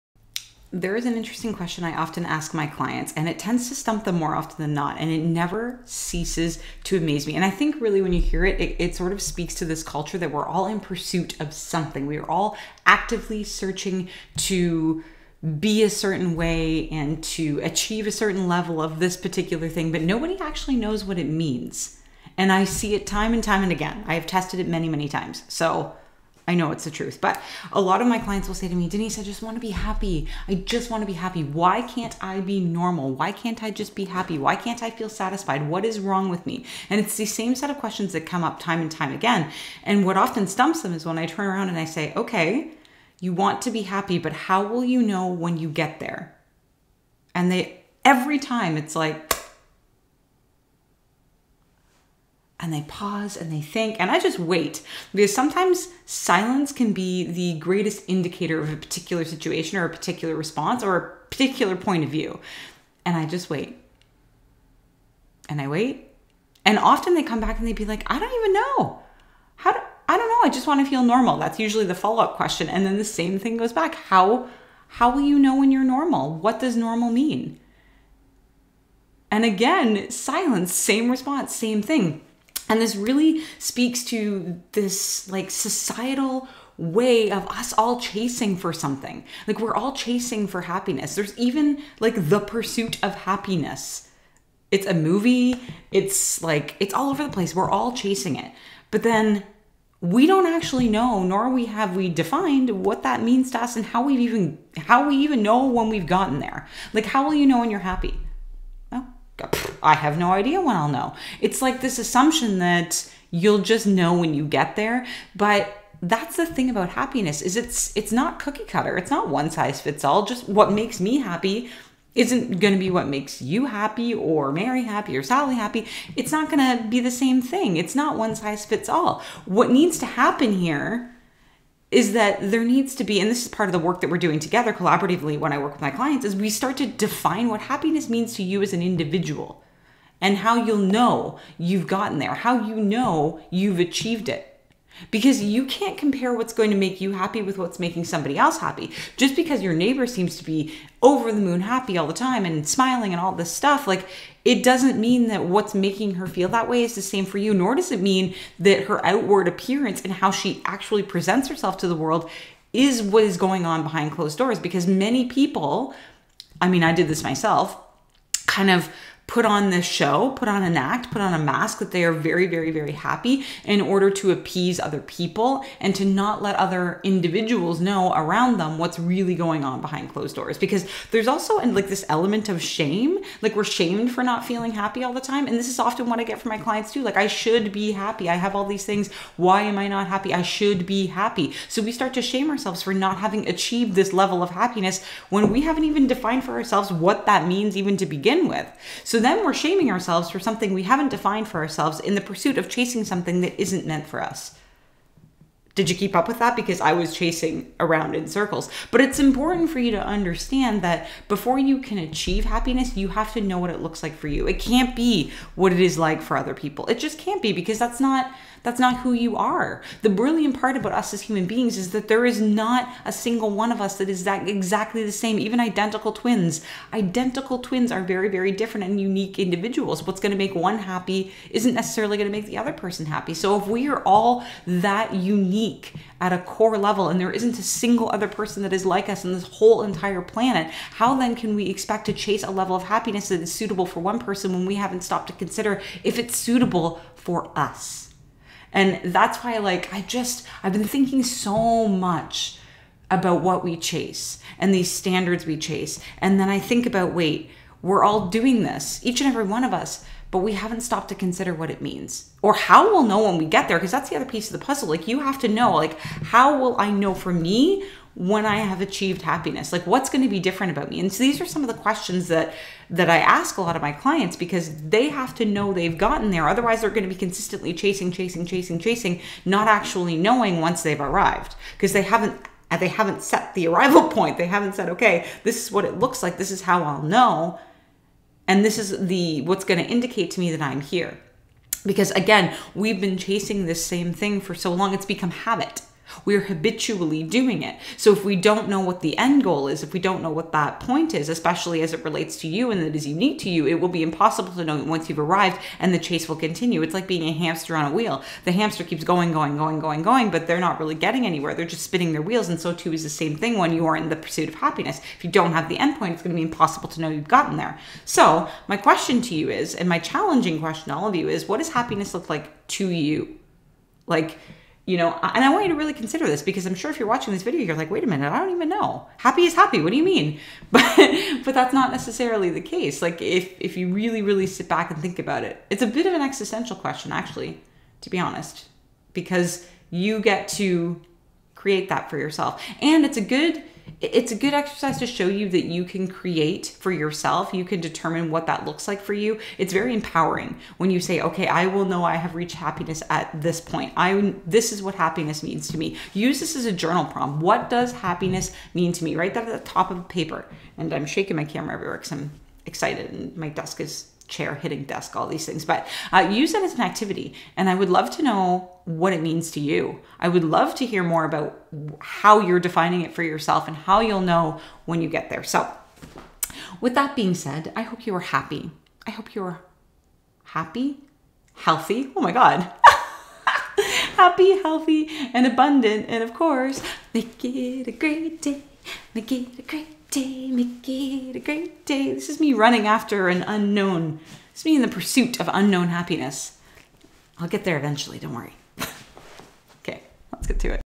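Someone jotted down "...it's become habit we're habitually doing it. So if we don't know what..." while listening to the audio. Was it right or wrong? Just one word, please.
right.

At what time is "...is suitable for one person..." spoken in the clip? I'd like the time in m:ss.
4:03.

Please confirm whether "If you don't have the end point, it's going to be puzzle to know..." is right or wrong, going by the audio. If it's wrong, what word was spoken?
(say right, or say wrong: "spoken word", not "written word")
wrong: "impossible", not "puzzle".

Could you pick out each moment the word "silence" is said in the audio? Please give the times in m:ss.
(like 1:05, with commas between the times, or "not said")
0:56, 1:20.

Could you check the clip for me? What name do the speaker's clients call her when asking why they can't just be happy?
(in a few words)
Denise.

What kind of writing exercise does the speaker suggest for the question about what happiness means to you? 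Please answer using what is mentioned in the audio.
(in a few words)
Journal prompt.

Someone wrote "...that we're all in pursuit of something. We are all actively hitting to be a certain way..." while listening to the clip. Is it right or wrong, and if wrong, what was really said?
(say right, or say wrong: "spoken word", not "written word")
wrong: "searching", not "hitting".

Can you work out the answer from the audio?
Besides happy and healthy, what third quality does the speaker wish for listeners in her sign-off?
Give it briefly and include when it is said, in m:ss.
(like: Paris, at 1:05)
Abundant, at 6:25.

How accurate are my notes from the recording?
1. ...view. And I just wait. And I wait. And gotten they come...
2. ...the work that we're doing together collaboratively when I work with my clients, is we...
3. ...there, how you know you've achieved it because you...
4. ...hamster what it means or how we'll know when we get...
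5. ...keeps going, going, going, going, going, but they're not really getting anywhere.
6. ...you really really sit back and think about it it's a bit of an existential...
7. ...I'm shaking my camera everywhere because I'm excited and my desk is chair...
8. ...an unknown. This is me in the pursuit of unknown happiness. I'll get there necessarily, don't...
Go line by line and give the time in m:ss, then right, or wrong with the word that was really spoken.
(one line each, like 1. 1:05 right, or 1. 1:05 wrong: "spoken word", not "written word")
1. 1:02 wrong: "often", not "gotten"
2. 2:13 right
3. 2:22 right
4. 4:21 wrong: "consider", not "hamster"
5. 5:08 right
6. 5:33 right
7. 6:00 right
8. 6:33 wrong: "eventually", not "necessarily".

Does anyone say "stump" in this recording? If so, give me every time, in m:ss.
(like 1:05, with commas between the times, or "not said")
0:03, 0:40.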